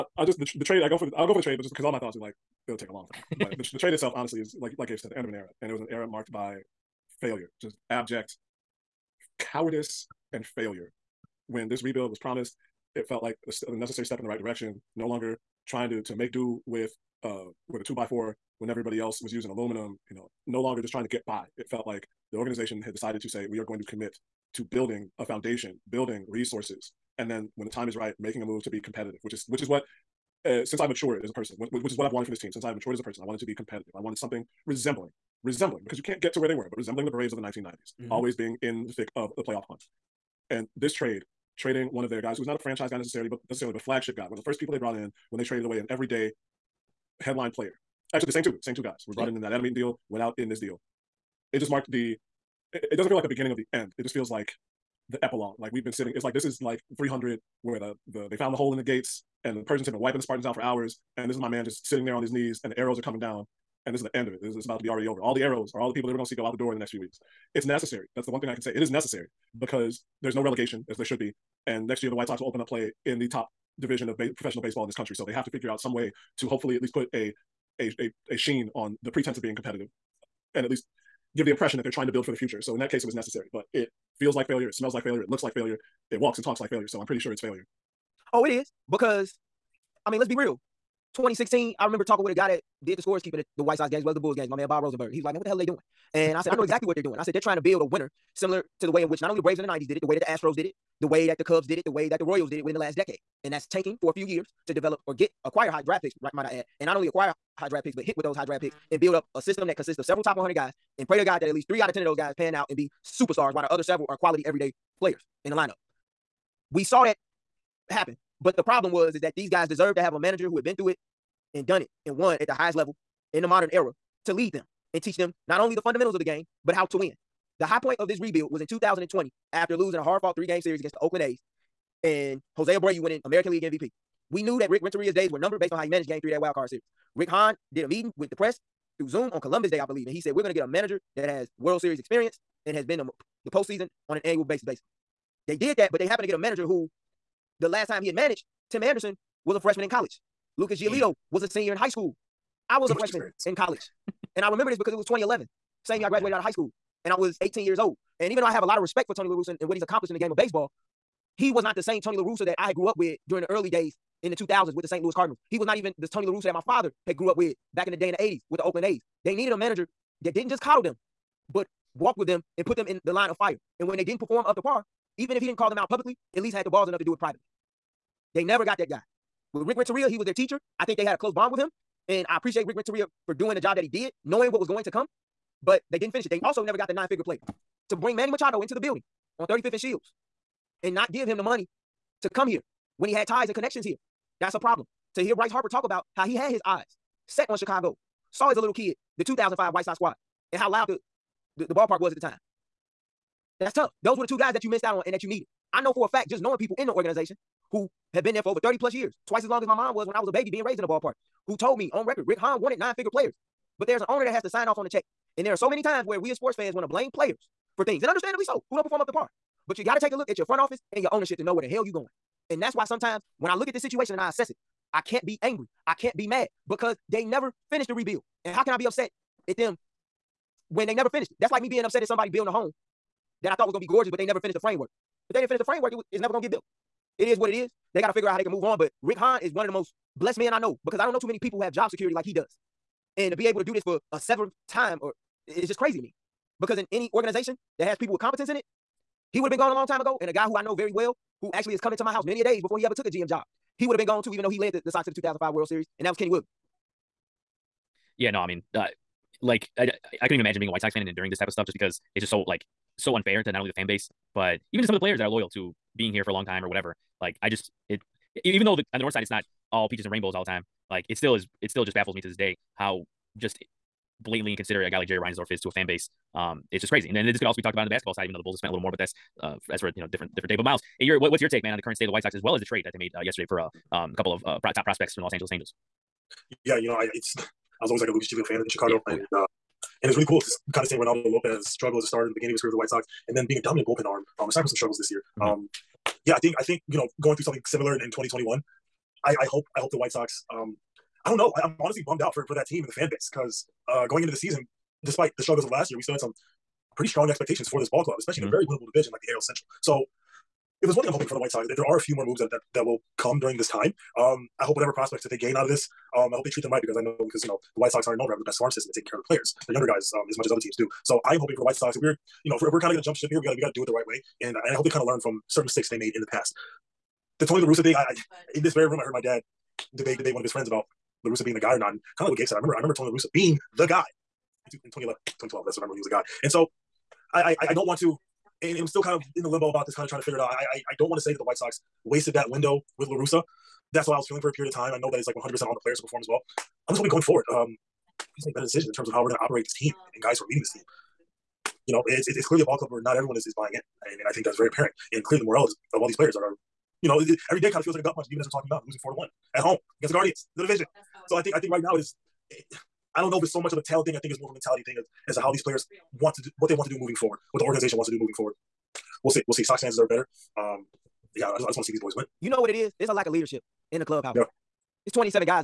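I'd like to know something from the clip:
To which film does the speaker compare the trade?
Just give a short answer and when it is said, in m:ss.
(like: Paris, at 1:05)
300, at 0:56.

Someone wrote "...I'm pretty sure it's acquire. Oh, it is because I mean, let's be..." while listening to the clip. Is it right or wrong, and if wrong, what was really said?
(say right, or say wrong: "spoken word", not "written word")
wrong: "failure", not "acquire".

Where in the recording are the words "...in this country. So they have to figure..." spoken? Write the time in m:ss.
1:14.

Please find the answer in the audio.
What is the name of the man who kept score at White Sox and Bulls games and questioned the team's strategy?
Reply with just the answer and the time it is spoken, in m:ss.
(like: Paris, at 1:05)
Bob Rosenberg, at 1:34.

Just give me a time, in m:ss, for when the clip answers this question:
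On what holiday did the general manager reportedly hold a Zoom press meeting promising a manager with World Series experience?
2:19.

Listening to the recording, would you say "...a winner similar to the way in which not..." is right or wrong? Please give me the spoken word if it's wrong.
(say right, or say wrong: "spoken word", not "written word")
right.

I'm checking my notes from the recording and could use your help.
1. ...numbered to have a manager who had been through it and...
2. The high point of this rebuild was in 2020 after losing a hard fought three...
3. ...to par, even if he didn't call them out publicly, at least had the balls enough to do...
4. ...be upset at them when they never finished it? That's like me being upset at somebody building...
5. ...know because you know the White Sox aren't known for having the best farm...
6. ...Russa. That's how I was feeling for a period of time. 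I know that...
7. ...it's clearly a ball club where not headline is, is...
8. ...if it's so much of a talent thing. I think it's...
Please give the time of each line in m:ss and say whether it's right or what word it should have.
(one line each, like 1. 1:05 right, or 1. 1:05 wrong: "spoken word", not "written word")
1. 1:59 wrong: "deserved", not "numbered"
2. 2:07 right
3. 2:54 right
4. 3:48 right
5. 5:17 right
6. 5:43 right
7. 5:52 wrong: "everyone", not "headline"
8. 6:03 right.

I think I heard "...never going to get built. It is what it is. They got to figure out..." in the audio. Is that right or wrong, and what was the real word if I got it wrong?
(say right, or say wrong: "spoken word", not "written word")
right.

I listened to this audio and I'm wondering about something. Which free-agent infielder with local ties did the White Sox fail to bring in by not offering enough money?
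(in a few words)
Manny Machado.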